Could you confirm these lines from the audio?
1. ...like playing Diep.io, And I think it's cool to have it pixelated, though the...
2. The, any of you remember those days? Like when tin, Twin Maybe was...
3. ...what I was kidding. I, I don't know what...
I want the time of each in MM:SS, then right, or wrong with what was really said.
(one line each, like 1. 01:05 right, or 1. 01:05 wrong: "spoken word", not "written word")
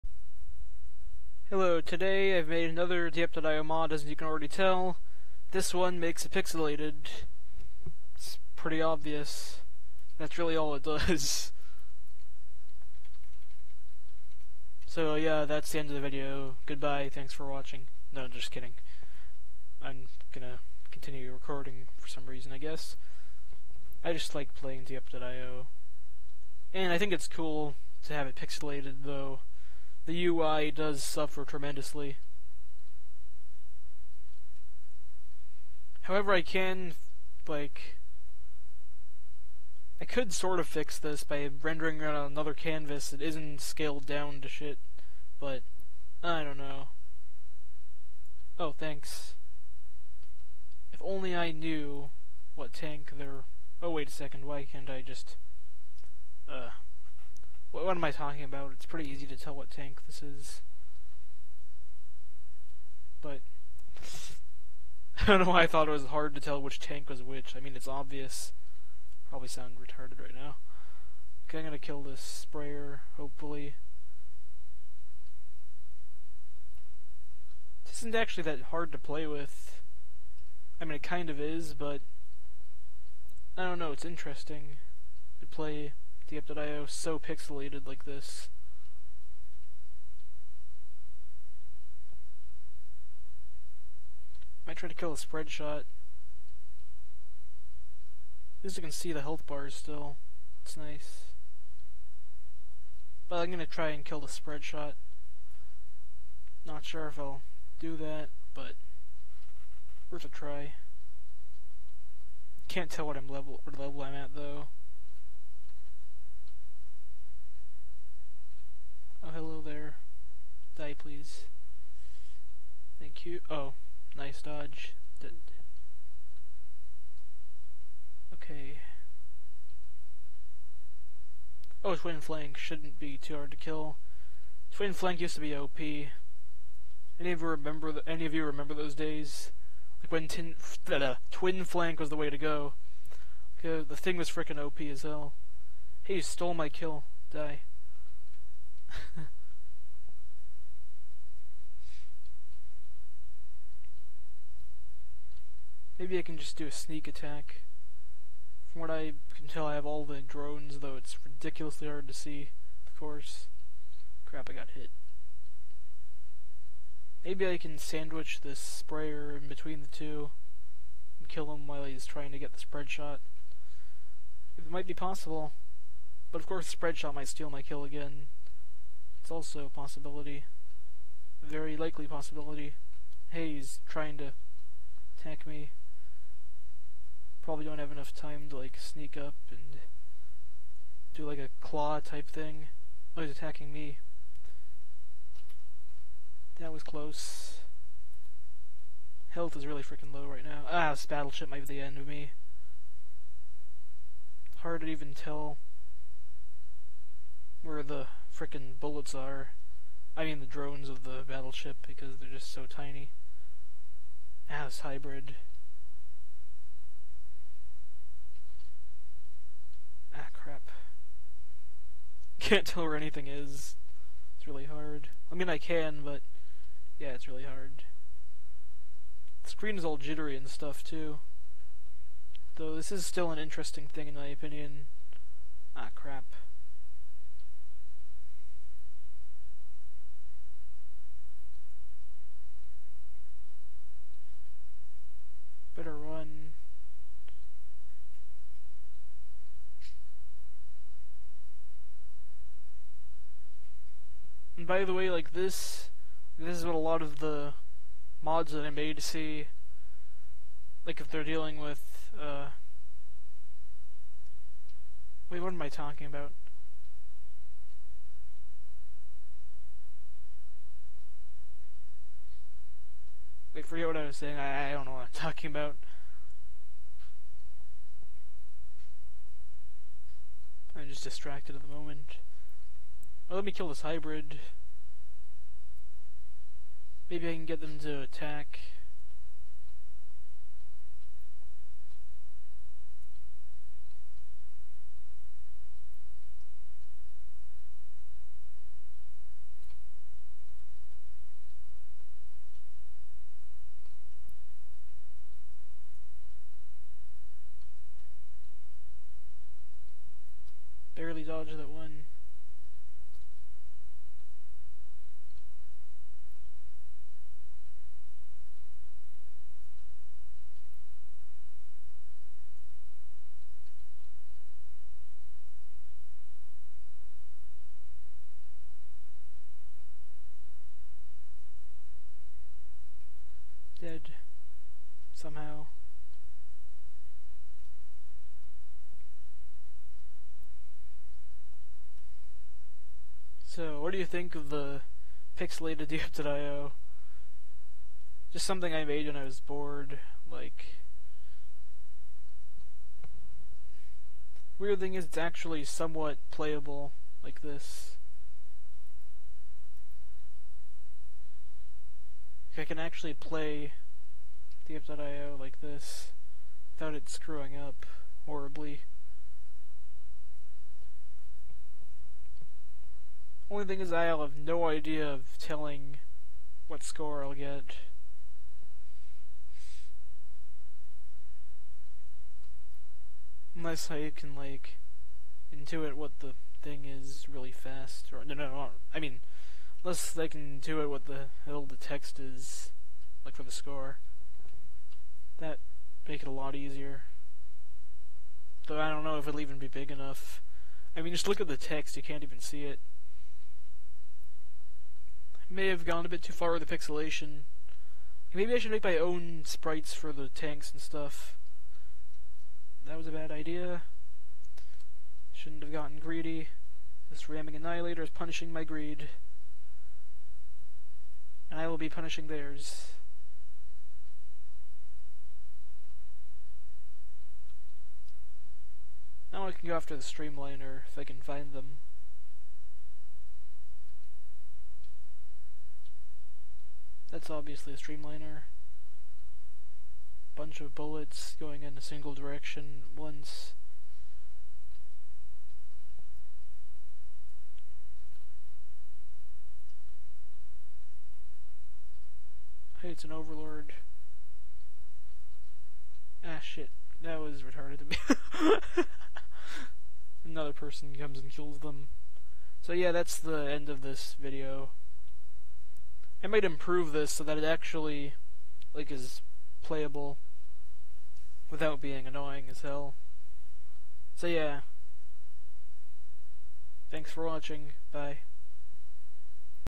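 1. 00:24 right
2. 02:17 wrong: "Flank", not "Maybe"
3. 04:33 wrong: "saying", not "kidding".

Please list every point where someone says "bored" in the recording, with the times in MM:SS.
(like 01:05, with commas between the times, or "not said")
05:49.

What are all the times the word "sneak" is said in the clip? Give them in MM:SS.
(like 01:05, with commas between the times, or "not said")
02:36, 03:08.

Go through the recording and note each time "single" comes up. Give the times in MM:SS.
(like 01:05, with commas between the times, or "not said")
07:21.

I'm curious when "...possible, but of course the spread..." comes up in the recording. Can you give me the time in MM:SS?
02:54.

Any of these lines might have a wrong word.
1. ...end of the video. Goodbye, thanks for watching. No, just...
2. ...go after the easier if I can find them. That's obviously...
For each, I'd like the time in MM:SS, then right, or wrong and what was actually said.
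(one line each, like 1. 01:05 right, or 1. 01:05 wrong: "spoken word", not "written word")
1. 00:15 right
2. 07:09 wrong: "streamliner", not "easier".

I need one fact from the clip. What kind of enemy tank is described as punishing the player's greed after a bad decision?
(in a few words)
Ramming annihilator.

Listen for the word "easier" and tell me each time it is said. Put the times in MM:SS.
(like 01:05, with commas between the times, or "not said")
06:36.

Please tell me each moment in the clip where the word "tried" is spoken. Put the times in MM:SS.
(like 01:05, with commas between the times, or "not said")
01:34.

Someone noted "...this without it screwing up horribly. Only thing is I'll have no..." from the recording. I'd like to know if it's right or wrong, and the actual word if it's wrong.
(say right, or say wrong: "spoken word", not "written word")
right.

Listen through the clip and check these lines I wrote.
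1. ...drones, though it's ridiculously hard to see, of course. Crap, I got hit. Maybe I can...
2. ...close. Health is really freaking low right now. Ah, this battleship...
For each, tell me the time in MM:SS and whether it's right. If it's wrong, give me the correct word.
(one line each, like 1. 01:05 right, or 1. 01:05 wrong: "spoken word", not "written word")
1. 02:40 right
2. 03:16 right.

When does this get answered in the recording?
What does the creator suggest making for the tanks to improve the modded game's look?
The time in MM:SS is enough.
06:48.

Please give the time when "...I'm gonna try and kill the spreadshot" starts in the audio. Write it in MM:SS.
01:43.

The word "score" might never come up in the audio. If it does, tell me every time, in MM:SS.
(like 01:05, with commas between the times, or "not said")
06:16, 06:33.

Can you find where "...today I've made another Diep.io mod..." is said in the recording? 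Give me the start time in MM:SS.
00:01.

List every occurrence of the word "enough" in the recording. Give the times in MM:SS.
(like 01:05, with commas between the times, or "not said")
03:07, 06:39.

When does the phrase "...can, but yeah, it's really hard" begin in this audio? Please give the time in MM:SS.
03:45.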